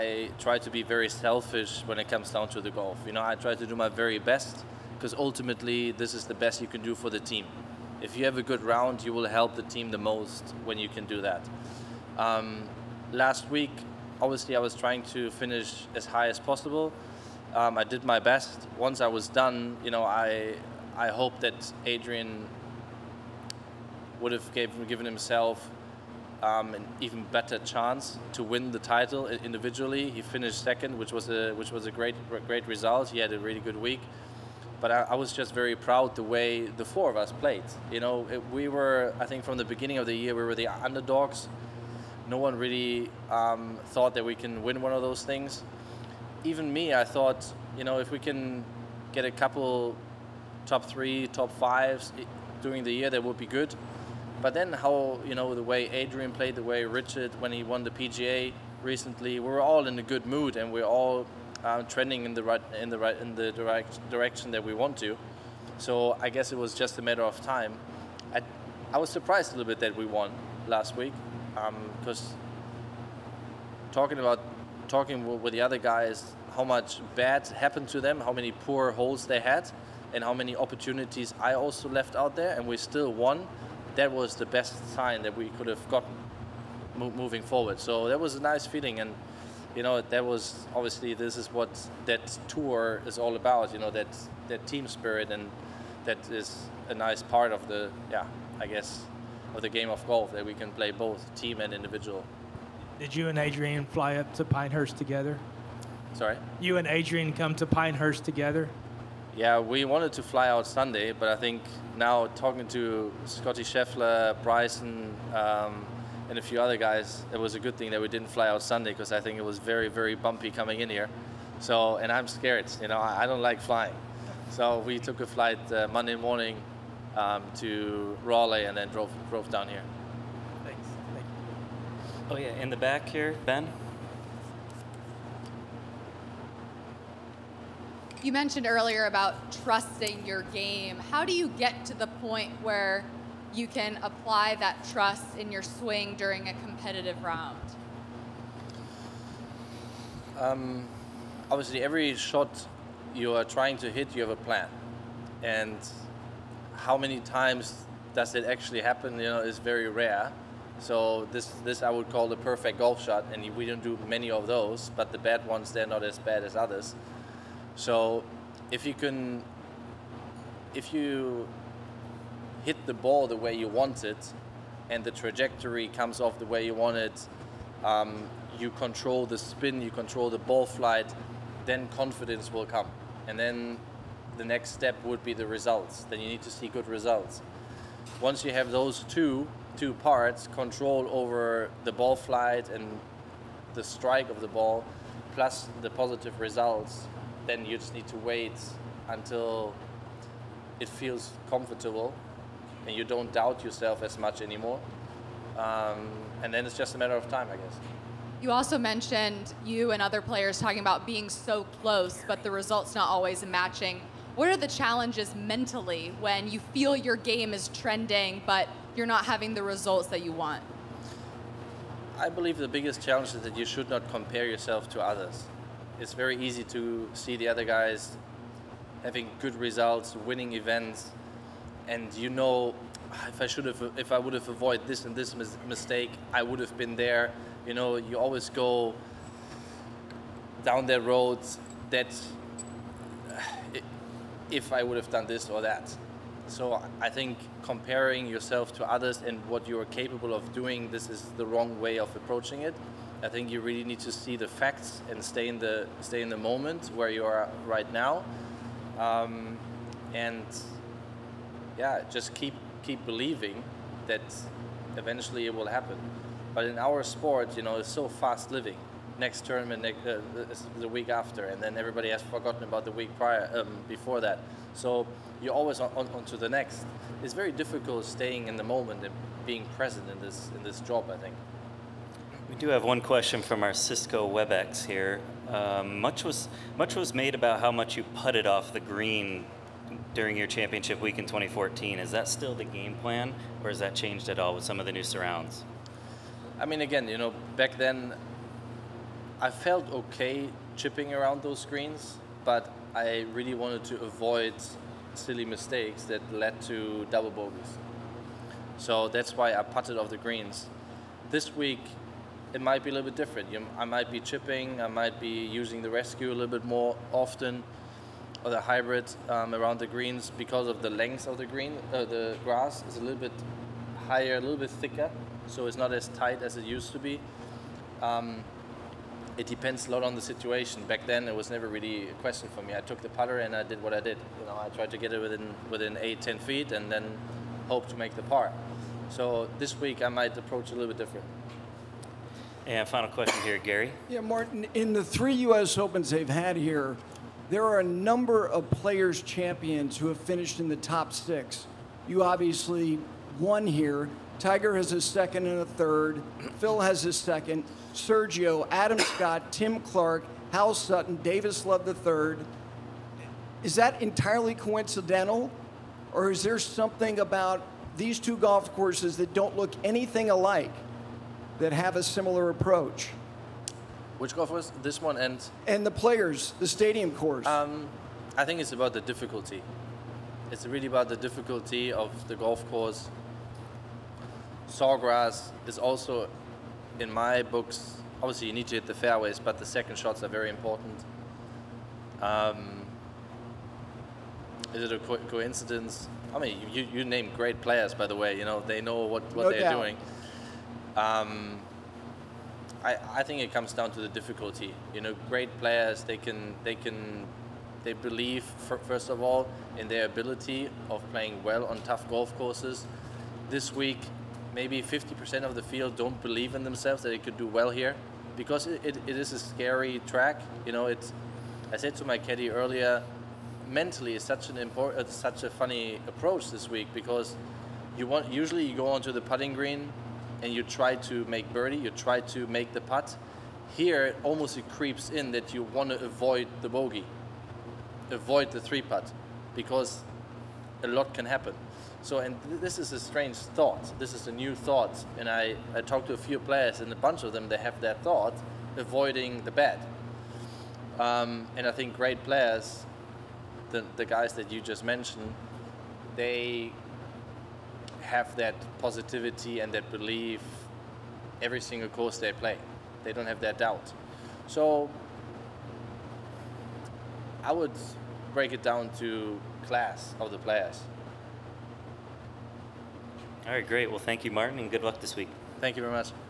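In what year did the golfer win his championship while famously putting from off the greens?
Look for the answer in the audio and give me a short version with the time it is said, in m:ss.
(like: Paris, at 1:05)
2014, at 4:51.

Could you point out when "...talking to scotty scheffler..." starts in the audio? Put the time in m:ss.
1:52.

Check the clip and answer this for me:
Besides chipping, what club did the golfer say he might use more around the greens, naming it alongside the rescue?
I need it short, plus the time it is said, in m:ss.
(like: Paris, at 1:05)
Hybrid, at 5:18.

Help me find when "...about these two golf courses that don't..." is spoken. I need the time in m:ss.
6:07.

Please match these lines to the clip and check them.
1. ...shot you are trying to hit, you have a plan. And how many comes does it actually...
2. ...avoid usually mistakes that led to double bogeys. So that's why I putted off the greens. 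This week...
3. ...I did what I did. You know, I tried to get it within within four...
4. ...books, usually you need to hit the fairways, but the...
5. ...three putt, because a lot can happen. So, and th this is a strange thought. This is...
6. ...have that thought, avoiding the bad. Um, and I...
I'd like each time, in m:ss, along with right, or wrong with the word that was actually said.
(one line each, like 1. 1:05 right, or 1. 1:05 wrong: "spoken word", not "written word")
1. 2:32 wrong: "times", not "comes"
2. 5:04 wrong: "silly", not "usually"
3. 5:33 wrong: "eight", not "four"
4. 6:27 wrong: "obviously", not "usually"
5. 7:18 right
6. 7:27 right.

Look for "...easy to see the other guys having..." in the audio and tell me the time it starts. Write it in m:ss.
3:46.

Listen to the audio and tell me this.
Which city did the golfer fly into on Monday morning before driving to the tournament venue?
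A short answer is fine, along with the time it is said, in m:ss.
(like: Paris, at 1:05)
Raleigh, at 2:08.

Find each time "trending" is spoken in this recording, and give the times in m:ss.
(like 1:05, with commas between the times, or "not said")
1:01, 3:37.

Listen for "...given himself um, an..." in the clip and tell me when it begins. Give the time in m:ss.
0:24.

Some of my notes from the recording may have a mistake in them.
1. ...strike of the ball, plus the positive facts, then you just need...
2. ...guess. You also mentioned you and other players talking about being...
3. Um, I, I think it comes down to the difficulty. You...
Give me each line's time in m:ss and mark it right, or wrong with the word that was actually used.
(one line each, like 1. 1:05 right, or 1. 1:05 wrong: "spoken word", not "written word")
1. 3:13 wrong: "results", not "facts"
2. 3:27 right
3. 6:40 right.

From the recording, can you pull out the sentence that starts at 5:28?
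Um, it depends a lot on the situation.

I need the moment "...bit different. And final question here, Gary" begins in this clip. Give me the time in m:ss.
5:40.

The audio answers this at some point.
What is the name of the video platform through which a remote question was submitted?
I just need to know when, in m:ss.
4:43.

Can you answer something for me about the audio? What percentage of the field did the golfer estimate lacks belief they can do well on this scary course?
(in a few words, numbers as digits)
50%.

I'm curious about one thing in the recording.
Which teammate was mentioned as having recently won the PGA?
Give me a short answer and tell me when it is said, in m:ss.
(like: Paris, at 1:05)
Richard, at 0:56.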